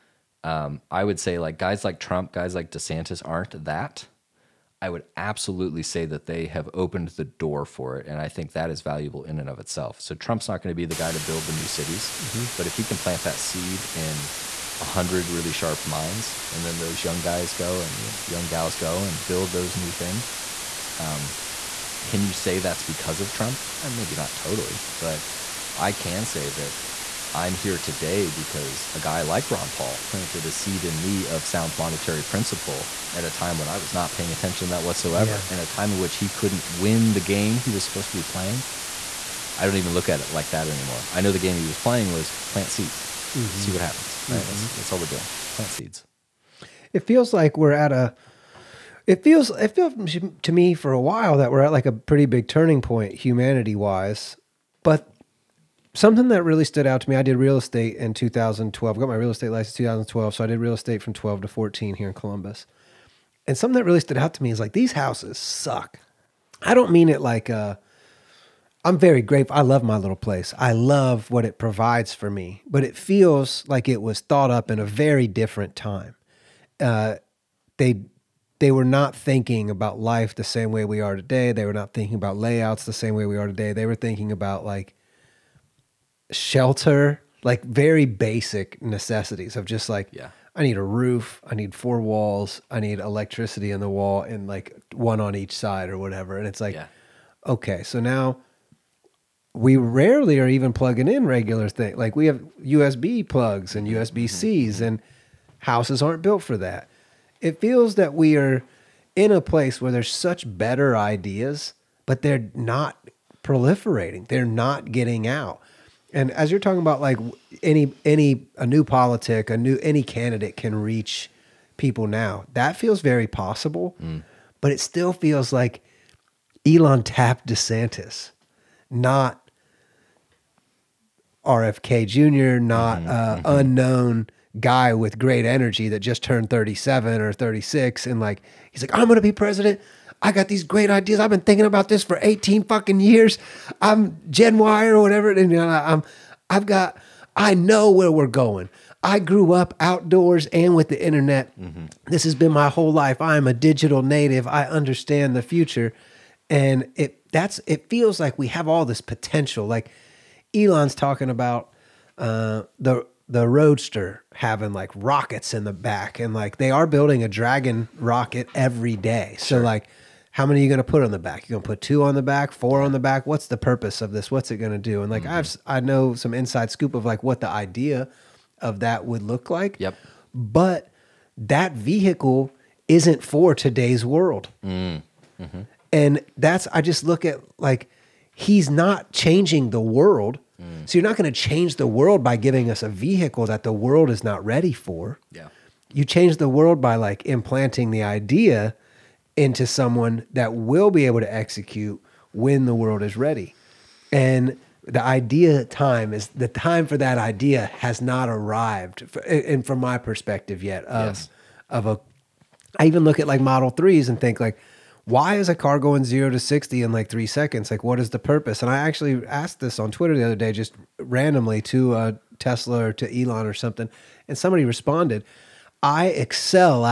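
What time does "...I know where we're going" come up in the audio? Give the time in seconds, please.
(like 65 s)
147 s.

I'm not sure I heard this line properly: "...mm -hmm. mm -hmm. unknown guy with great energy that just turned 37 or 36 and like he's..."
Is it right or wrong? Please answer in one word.
right.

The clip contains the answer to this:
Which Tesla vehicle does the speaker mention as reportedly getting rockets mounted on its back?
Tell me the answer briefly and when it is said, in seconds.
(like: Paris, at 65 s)
Roadster, at 163 s.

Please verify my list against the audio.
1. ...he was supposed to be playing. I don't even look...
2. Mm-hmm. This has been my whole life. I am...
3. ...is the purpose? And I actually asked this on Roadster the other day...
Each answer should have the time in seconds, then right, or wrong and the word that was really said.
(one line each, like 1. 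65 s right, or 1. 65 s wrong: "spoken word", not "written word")
1. 37 s right
2. 151 s right
3. 217 s wrong: "Twitter", not "Roadster".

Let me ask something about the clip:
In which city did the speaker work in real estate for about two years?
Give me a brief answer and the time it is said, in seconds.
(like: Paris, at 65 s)
Columbus, at 62 s.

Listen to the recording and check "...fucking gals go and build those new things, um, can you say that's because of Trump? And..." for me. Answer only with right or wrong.
wrong.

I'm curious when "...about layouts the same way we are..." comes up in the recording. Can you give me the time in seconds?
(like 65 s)
82 s.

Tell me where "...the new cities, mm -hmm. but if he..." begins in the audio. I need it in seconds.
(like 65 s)
11 s.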